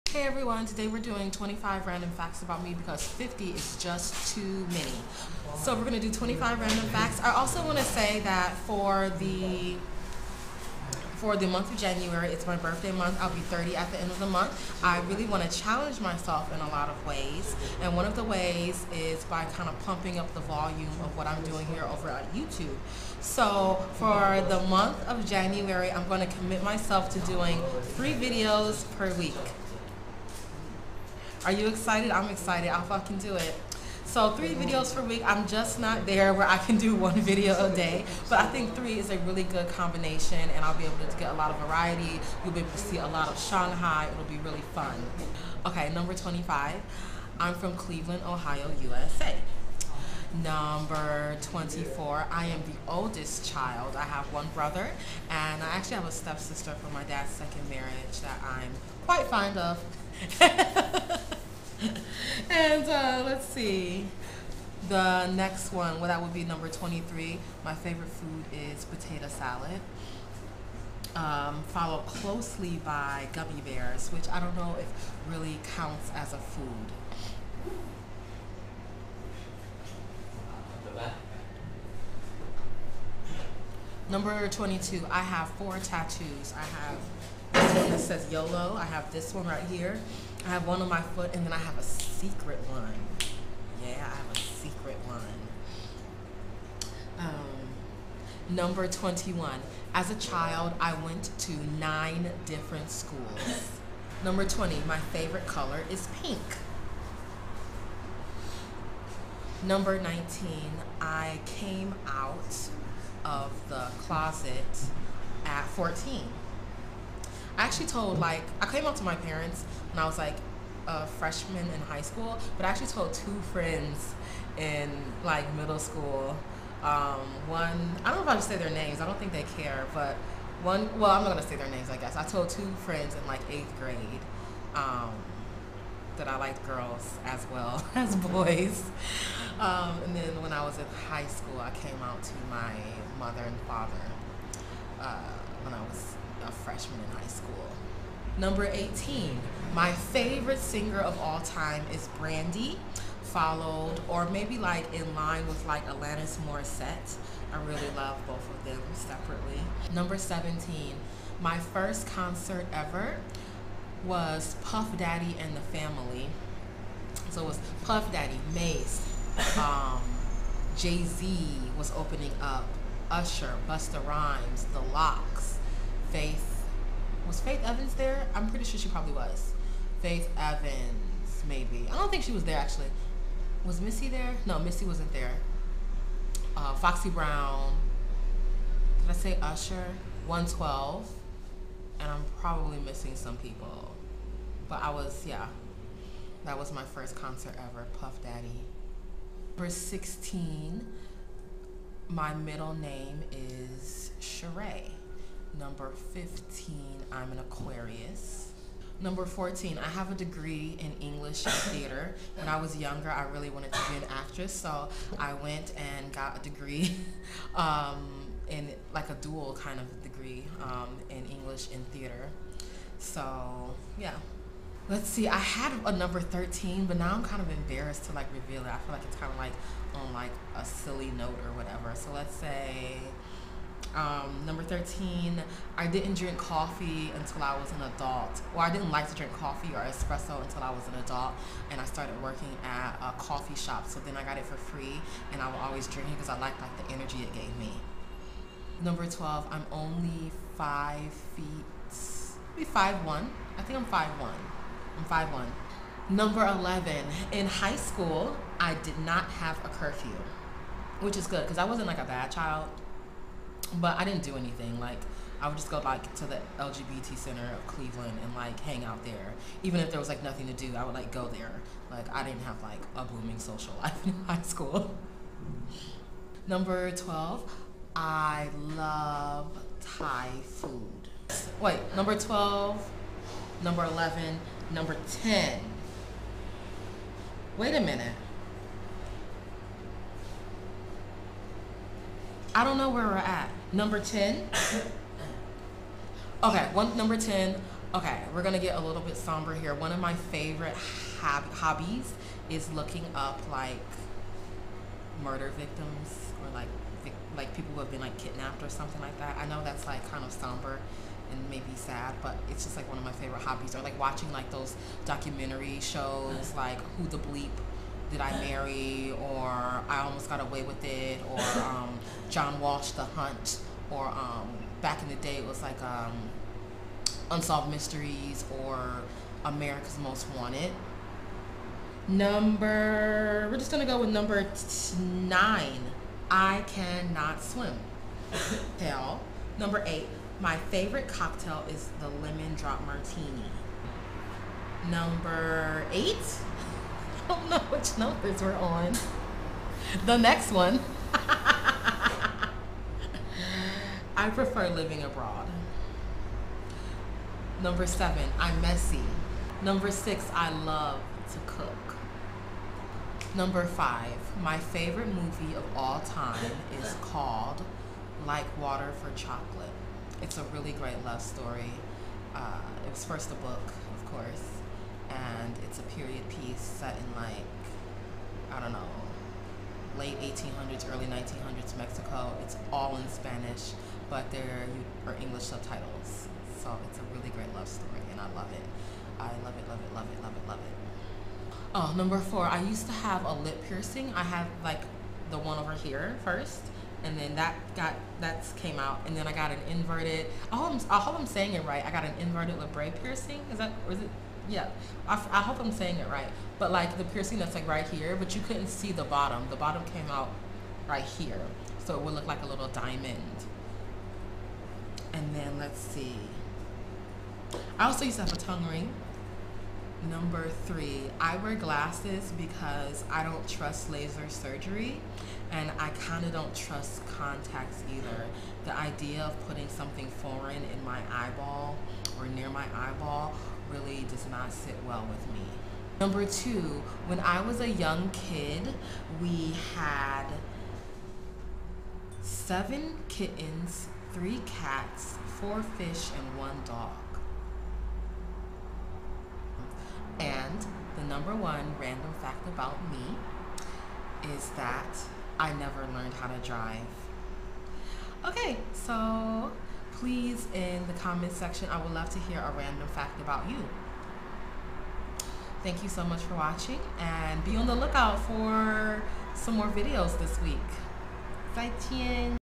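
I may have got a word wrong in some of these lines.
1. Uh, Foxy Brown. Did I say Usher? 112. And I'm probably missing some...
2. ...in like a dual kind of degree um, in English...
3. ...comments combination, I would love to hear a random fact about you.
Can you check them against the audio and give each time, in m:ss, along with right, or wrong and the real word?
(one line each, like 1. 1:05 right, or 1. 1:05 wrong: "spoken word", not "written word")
1. 3:06 right
2. 3:38 right
3. 7:40 wrong: "section", not "combination".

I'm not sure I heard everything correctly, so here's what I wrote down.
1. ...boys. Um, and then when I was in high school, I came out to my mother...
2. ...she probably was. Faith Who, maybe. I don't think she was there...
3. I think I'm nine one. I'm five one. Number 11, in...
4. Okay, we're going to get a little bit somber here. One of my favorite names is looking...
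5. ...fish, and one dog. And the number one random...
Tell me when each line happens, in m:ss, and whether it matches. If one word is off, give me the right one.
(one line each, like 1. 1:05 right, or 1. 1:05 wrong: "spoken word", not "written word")
1. 2:18 right
2. 2:58 wrong: "Evans", not "Who"
3. 4:13 wrong: "five", not "nine"
4. 4:57 wrong: "hobbies", not "names"
5. 7:25 right.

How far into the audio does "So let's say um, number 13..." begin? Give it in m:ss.
3:51.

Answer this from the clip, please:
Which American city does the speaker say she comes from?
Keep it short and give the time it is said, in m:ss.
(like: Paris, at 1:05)
Cleveland, Ohio, at 0:47.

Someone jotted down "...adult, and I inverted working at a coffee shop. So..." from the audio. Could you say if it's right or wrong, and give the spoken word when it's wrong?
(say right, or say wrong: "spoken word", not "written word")
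wrong: "started", not "inverted".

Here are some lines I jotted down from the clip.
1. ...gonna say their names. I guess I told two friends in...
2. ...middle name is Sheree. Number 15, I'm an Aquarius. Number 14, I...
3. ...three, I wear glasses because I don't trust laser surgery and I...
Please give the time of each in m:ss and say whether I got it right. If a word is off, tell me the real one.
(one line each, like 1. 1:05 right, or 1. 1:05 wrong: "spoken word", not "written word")
1. 2:11 right
2. 3:22 right
3. 7:00 right.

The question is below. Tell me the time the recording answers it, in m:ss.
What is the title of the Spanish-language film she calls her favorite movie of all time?
6:08.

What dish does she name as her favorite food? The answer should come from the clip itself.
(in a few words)
Potato salad.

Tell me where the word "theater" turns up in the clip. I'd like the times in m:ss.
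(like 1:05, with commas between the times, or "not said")
3:31, 3:41.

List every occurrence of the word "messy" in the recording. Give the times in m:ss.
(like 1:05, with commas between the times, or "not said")
5:58.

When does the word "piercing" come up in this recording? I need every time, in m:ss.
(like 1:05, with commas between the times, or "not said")
6:33, 6:43, 6:47.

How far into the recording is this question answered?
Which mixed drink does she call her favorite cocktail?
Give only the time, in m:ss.
5:42.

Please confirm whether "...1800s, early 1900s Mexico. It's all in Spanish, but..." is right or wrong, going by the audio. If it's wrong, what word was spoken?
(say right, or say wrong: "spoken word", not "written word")
right.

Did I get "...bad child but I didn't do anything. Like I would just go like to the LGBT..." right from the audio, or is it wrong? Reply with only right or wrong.
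right.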